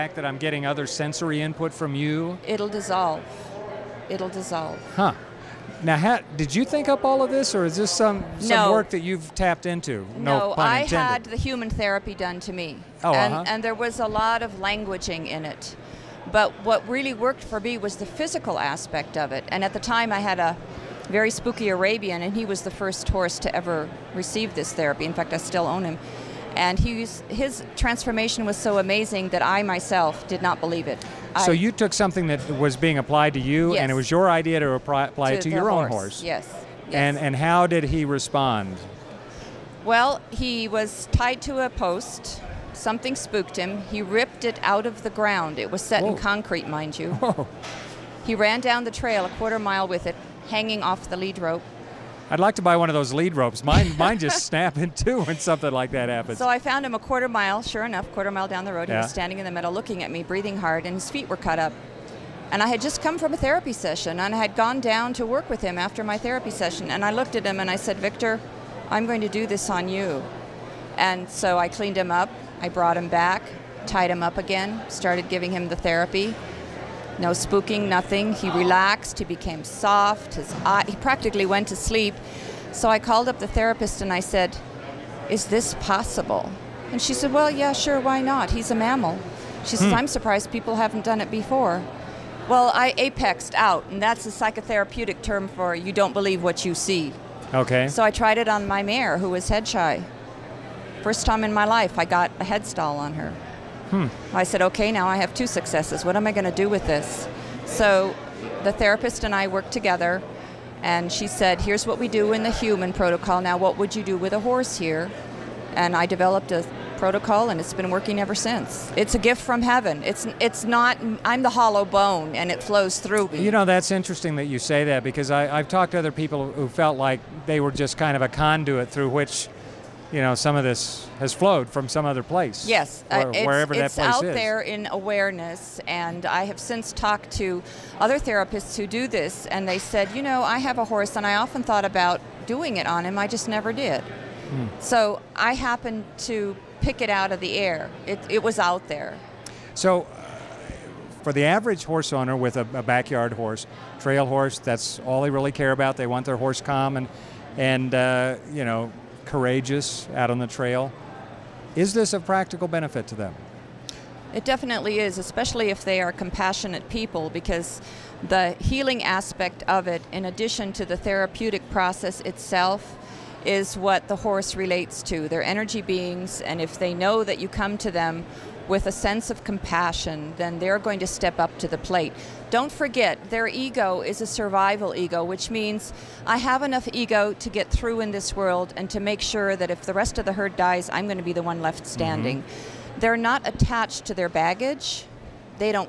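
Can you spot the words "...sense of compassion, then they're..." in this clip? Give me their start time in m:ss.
2:58.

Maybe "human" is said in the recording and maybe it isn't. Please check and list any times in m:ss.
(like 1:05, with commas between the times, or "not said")
0:11, 1:52.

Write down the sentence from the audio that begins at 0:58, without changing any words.
He was standing in the middle looking at me, breathing hard, and his feet were cut up.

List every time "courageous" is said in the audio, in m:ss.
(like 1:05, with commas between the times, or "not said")
2:39.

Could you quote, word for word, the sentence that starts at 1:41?
First time in my life, I got a head stall on her.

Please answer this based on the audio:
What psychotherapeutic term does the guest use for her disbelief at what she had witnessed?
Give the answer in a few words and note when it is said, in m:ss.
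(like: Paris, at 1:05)
apexed out, at 1:32.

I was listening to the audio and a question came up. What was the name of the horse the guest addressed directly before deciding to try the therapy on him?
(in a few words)
Victor.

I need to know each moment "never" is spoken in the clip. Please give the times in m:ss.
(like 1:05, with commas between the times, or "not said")
2:23.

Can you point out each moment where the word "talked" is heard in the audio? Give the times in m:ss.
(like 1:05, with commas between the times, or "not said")
2:05, 2:16.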